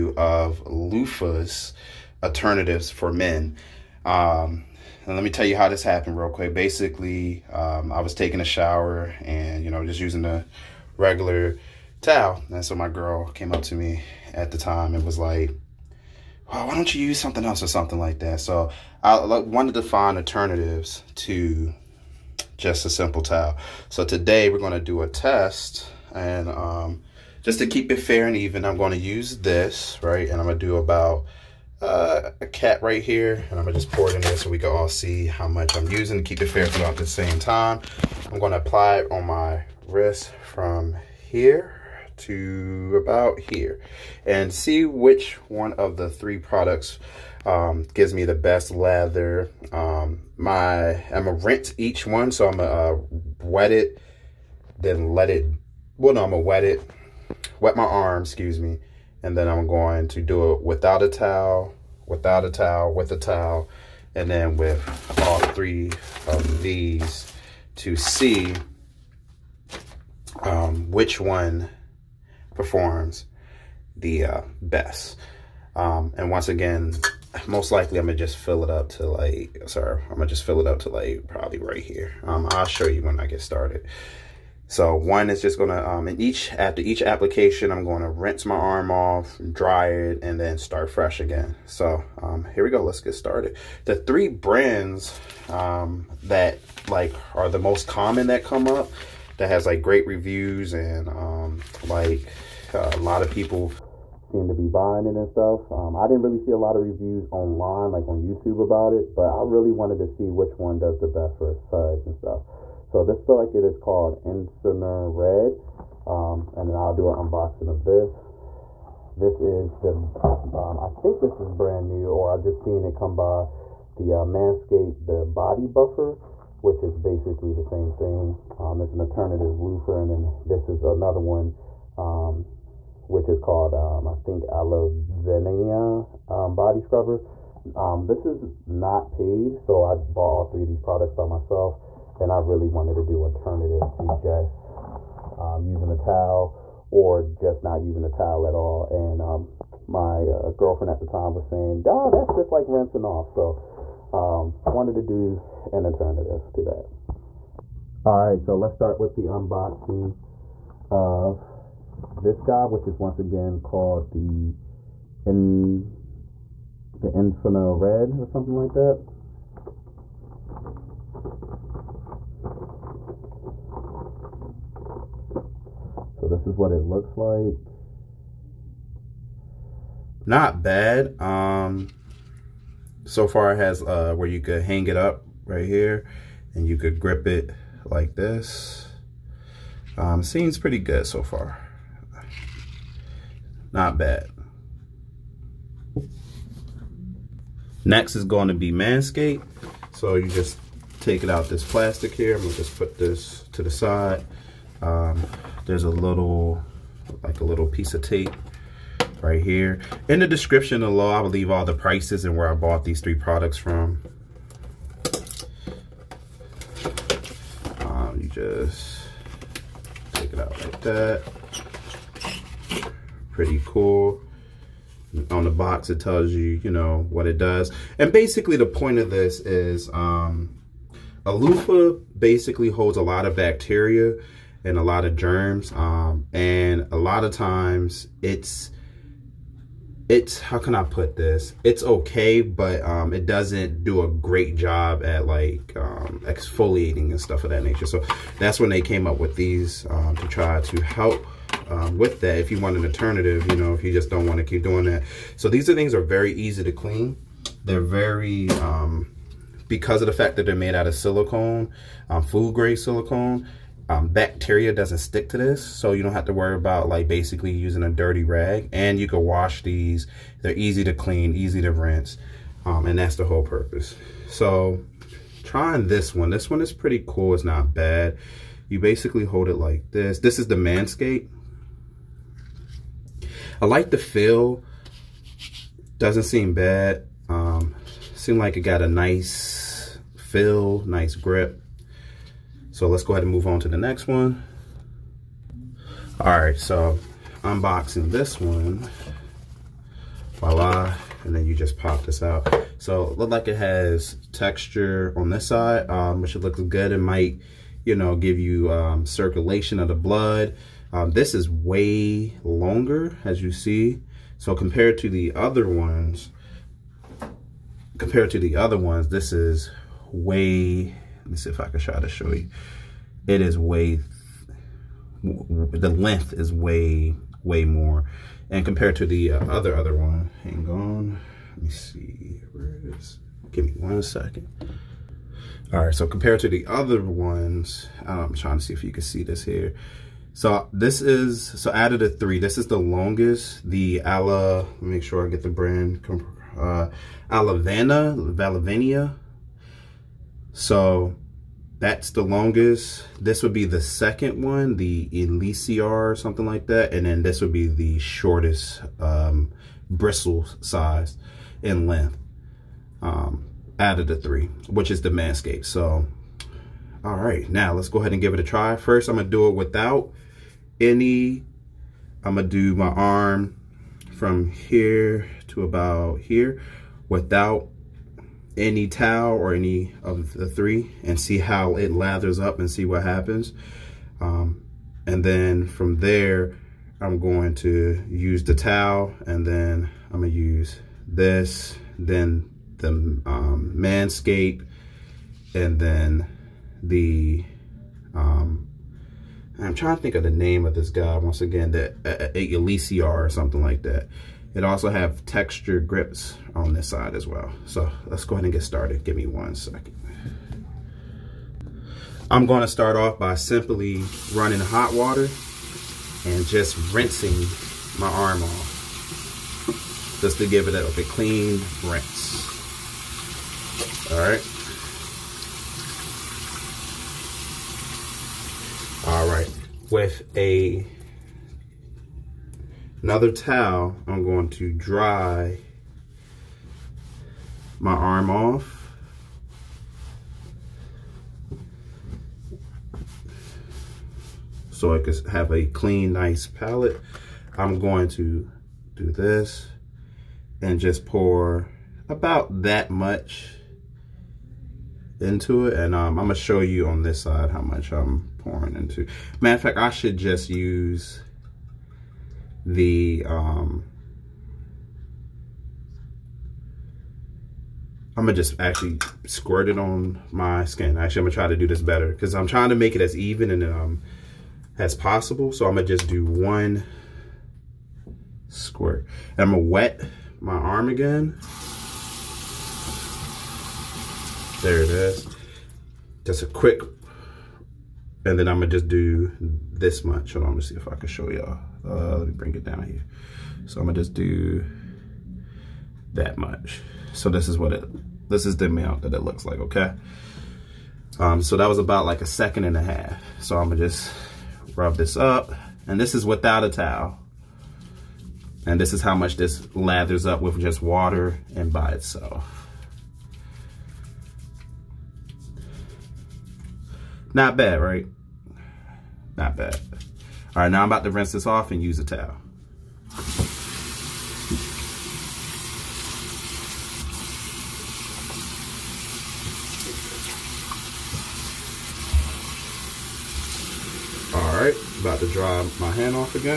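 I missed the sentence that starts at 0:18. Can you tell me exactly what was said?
So I wanted to find alternatives to just a simple towel.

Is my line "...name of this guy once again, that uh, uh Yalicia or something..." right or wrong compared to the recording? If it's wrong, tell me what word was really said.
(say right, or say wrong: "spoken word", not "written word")
right.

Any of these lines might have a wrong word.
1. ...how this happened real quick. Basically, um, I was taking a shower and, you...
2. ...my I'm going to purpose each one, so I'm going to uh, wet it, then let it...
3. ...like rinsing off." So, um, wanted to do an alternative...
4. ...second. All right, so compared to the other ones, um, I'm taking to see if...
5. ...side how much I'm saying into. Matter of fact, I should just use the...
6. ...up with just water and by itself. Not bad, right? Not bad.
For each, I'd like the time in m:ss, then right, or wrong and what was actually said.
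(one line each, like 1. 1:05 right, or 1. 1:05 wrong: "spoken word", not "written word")
1. 0:05 right
2. 0:50 wrong: "rinse", not "purpose"
3. 2:32 right
4. 5:34 wrong: "trying", not "taking"
5. 7:37 wrong: "pouring", not "saying"
6. 8:30 right.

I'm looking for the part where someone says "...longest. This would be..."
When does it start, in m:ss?
5:52.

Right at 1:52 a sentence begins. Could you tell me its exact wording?
So this look like it is called Incerner Red.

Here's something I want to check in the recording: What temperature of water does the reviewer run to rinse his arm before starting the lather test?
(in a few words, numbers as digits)
hot.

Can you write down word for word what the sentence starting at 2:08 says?
Um, it's an alternative loofah, and then this is another one, um, which is called, um, I think, Alavenia um, Body Scrubber.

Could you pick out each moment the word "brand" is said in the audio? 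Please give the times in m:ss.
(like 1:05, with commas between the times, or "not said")
1:34, 2:01, 5:45.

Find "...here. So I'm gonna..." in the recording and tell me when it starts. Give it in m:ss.
8:12.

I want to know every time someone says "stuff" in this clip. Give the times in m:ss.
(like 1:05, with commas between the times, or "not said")
1:45, 1:52, 4:07.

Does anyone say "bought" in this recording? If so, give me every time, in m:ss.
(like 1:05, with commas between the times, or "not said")
2:19, 3:32.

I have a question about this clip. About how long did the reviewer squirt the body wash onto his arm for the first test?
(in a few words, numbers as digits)
a second and a half.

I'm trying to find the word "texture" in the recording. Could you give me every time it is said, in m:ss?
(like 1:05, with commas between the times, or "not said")
5:04, 6:45.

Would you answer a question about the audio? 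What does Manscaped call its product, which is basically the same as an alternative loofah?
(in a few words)
body buffer.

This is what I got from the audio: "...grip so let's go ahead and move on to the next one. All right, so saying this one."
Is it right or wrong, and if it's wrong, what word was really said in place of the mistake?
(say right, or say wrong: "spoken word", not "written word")
wrong: "unboxing", not "saying".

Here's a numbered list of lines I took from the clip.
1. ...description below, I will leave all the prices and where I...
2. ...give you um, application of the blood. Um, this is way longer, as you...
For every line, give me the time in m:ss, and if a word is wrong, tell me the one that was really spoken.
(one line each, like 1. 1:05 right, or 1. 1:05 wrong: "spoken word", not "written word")
1. 3:30 right
2. 5:08 wrong: "circulation", not "application".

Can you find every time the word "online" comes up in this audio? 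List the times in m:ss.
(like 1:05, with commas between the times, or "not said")
1:47.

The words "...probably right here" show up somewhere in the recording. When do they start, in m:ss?
1:21.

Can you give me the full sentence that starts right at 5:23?
It is way, the length is way, way more.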